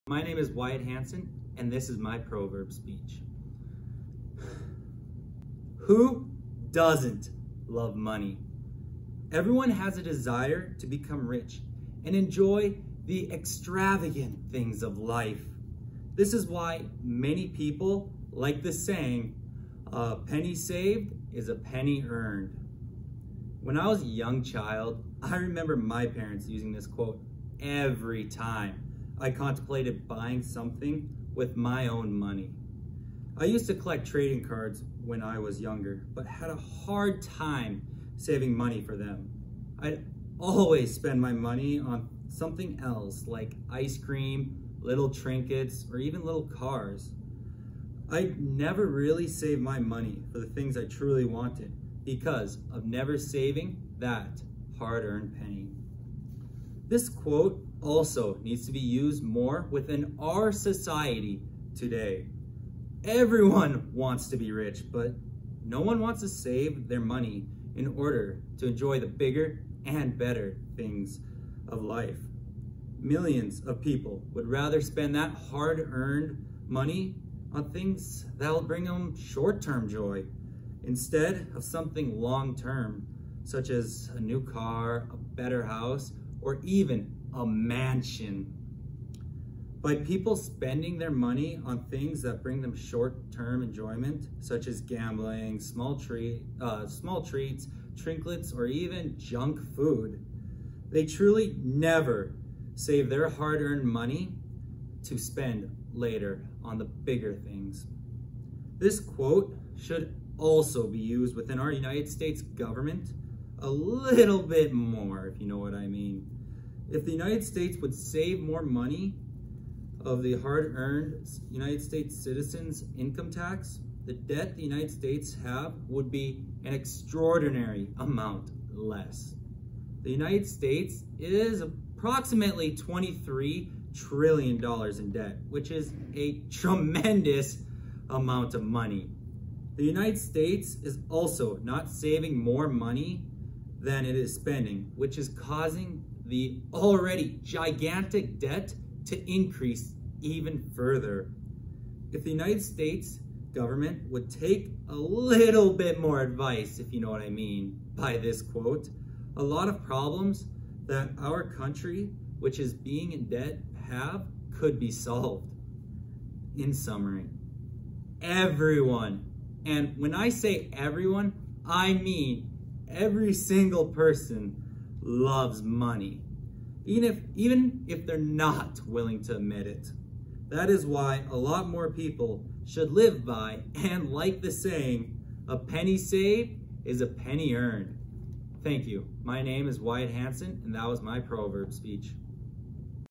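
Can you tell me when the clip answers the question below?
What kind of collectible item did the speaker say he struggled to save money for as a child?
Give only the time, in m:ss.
0:34.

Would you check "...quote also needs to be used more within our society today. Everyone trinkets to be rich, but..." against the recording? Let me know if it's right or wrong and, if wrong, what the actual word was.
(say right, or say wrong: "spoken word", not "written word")
wrong: "wants", not "trinkets".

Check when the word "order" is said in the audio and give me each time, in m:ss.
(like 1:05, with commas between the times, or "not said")
1:07.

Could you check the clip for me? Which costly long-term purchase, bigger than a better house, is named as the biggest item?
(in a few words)
A mansion.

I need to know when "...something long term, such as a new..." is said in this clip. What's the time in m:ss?
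1:21.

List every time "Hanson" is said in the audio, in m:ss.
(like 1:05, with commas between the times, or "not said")
0:00, 3:10.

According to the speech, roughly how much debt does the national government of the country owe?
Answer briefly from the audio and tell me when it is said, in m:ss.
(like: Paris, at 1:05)
$23 trillion, at 2:12.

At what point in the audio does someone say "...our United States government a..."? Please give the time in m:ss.
1:51.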